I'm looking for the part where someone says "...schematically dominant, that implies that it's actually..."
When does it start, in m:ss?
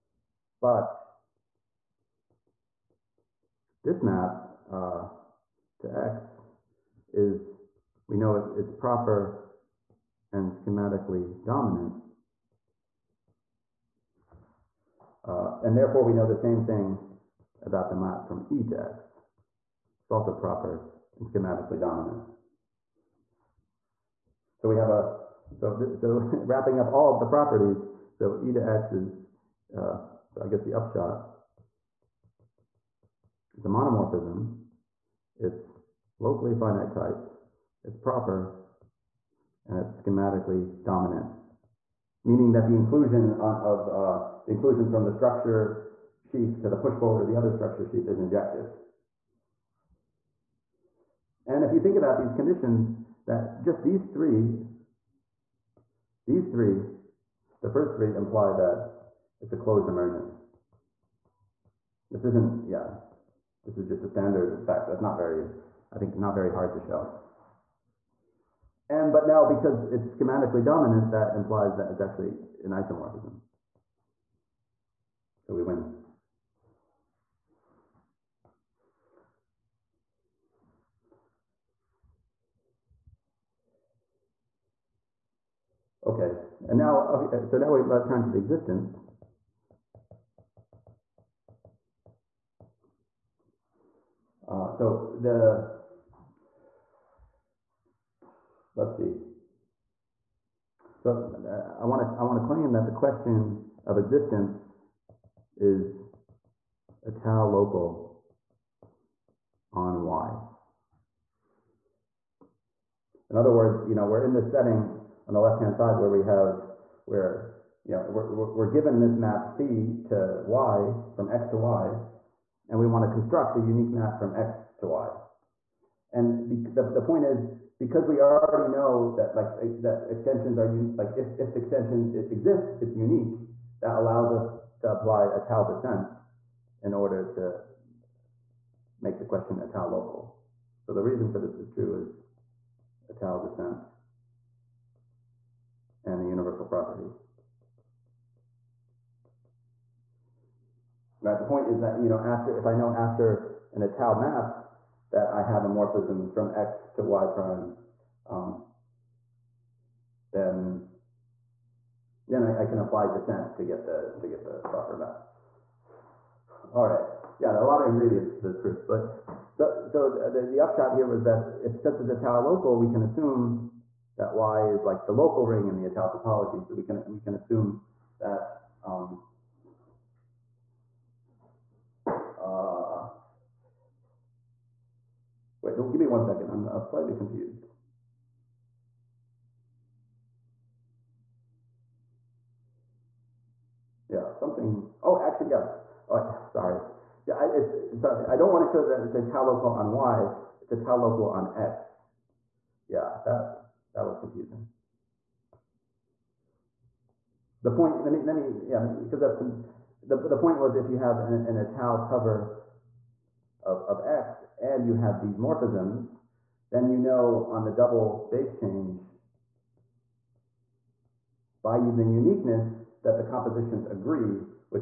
1:10.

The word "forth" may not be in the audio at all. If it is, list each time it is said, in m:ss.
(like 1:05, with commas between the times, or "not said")
not said.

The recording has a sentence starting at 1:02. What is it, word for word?
This isn't, yeah, this is just a standard fact.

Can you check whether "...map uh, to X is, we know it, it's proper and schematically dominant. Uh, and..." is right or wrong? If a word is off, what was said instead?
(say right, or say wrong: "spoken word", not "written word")
right.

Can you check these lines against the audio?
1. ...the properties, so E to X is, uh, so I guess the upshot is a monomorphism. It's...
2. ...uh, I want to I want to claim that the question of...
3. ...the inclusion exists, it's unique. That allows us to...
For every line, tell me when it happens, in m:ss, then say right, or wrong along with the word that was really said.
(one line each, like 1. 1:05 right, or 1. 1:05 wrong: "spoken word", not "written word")
1. 0:27 right
2. 1:41 right
3. 2:11 wrong: "extension", not "inclusion".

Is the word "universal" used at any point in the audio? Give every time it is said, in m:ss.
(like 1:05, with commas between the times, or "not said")
2:26.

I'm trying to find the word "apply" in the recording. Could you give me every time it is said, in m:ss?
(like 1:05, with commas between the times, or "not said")
2:14, 2:42.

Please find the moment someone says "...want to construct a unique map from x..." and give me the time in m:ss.
2:02.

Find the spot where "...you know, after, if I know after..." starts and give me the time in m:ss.
2:32.